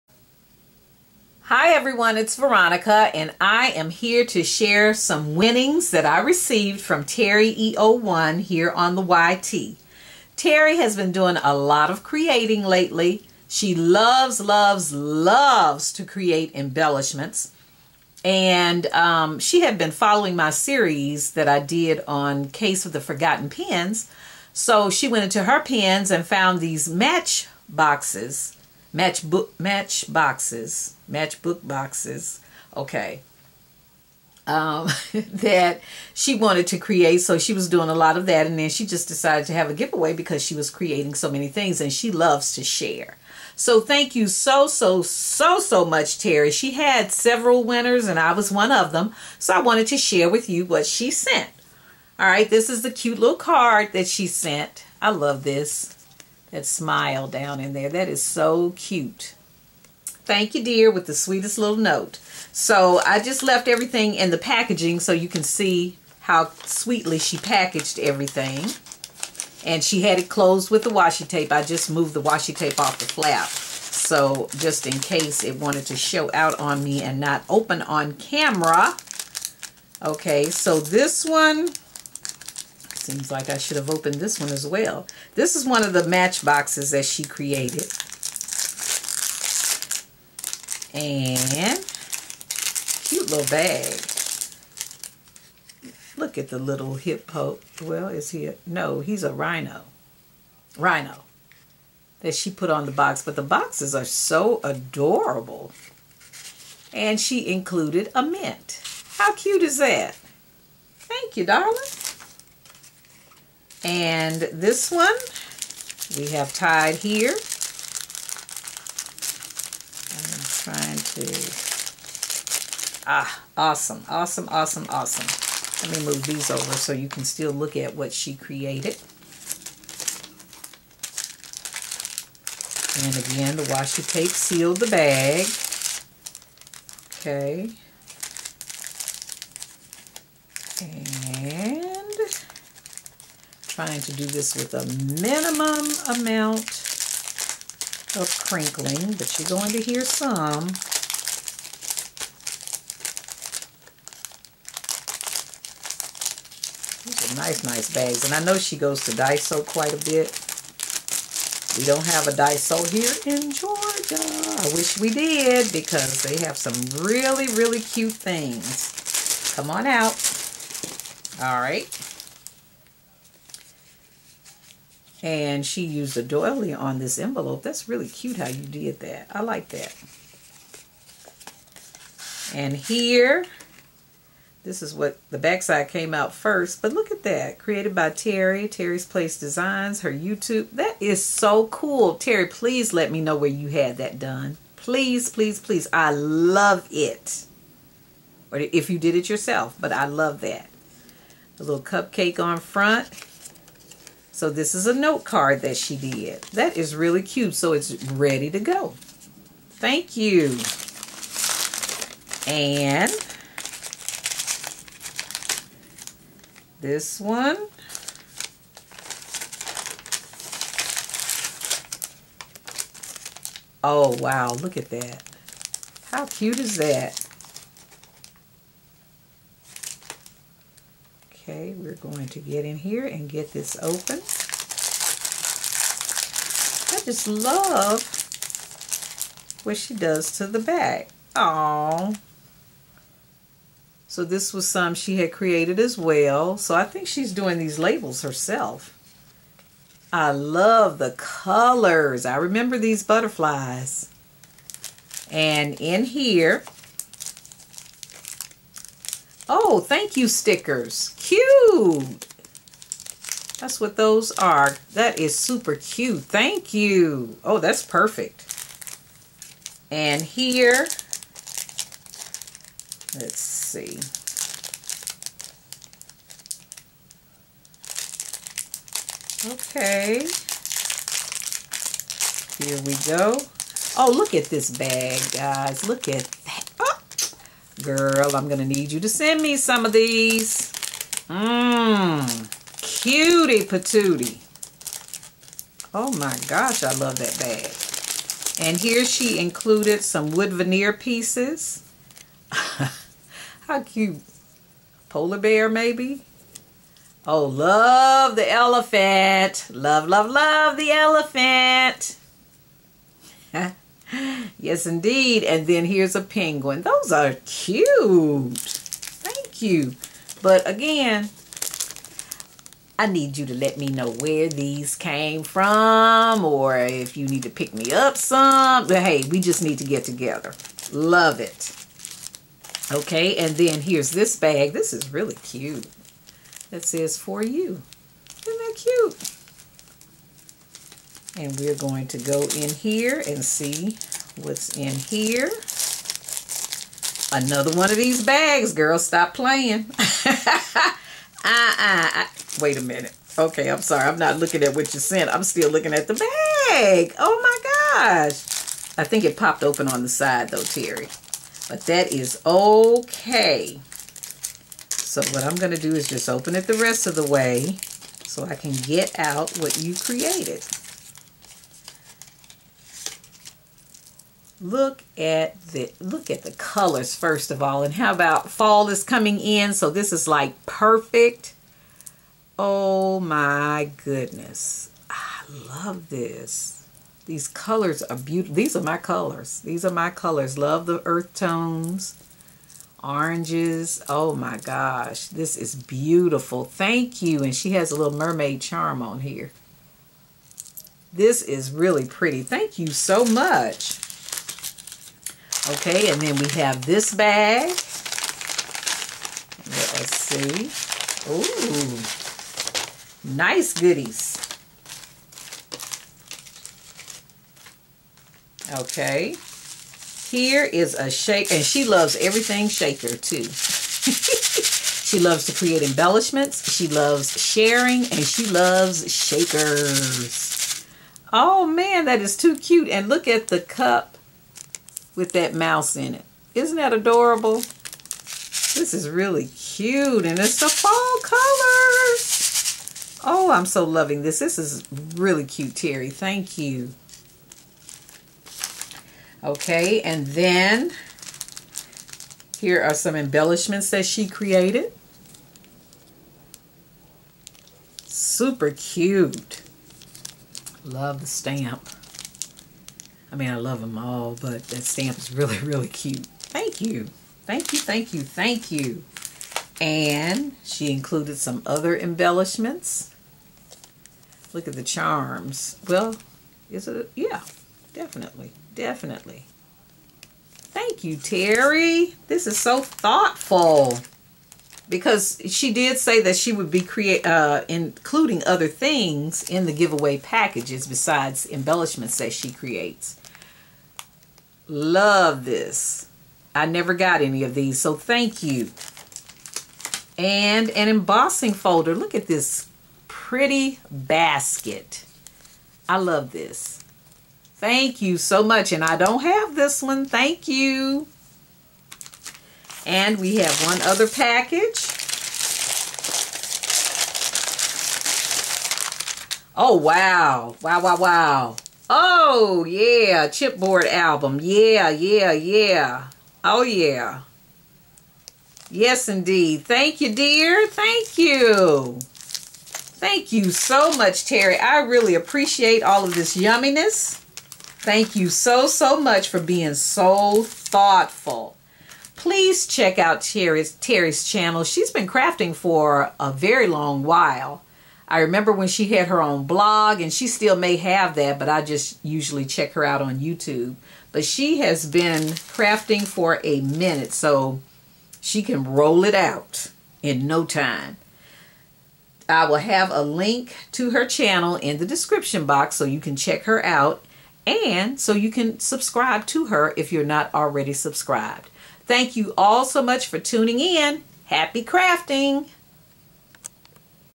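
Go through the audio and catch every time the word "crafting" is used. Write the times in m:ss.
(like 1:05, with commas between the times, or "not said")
9:05, 9:15, 9:34.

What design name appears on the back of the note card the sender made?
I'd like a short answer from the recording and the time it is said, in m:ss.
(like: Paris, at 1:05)
Terry's Place Designs, at 3:08.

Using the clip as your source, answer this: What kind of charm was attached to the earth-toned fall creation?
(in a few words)
Mermaid charm.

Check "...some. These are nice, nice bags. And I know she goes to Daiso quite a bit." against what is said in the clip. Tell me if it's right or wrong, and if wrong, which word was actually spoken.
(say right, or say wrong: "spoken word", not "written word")
right.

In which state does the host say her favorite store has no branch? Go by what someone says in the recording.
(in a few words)
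Georgia.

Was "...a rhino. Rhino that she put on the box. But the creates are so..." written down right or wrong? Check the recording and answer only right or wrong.
wrong.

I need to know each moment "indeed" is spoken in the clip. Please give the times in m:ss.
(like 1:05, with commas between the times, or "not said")
5:14, 8:49.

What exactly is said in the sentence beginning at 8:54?
I really appreciate all of this yumminess.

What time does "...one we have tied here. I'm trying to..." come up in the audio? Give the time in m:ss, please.
1:54.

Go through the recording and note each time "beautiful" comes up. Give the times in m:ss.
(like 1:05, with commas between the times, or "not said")
6:28, 6:35.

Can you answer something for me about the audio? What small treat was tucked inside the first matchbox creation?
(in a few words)
A mint.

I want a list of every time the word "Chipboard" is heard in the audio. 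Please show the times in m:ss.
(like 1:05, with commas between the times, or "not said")
8:43.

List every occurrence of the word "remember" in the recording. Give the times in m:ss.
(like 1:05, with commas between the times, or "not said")
4:12, 9:08.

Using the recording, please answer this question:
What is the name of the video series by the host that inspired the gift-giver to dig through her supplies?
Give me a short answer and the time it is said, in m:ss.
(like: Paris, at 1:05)
Case of the Forgotten Pens, at 0:22.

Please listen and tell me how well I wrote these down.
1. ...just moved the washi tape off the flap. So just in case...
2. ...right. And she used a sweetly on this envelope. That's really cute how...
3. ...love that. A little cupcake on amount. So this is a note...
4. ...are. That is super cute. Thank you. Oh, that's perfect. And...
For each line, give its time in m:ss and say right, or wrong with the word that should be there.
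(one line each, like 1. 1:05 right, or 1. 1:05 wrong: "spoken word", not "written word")
1. 1:11 right
2. 2:51 wrong: "doily", not "sweetly"
3. 3:20 wrong: "front", not "amount"
4. 4:24 right.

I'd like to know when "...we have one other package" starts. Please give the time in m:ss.
8:33.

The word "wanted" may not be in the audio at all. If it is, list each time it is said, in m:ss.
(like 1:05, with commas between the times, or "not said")
0:36, 0:49, 1:15.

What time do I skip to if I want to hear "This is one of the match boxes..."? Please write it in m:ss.
1:25.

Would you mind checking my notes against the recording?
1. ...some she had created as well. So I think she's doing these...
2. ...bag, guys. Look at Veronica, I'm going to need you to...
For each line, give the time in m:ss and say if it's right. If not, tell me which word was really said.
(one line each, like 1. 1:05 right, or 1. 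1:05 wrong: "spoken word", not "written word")
1. 4:04 right
2. 4:44 wrong: "Girl", not "Veronica".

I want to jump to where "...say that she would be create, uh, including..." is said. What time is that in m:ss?
8:05.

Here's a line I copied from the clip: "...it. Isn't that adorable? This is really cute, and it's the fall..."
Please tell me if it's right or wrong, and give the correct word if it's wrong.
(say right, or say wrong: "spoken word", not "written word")
right.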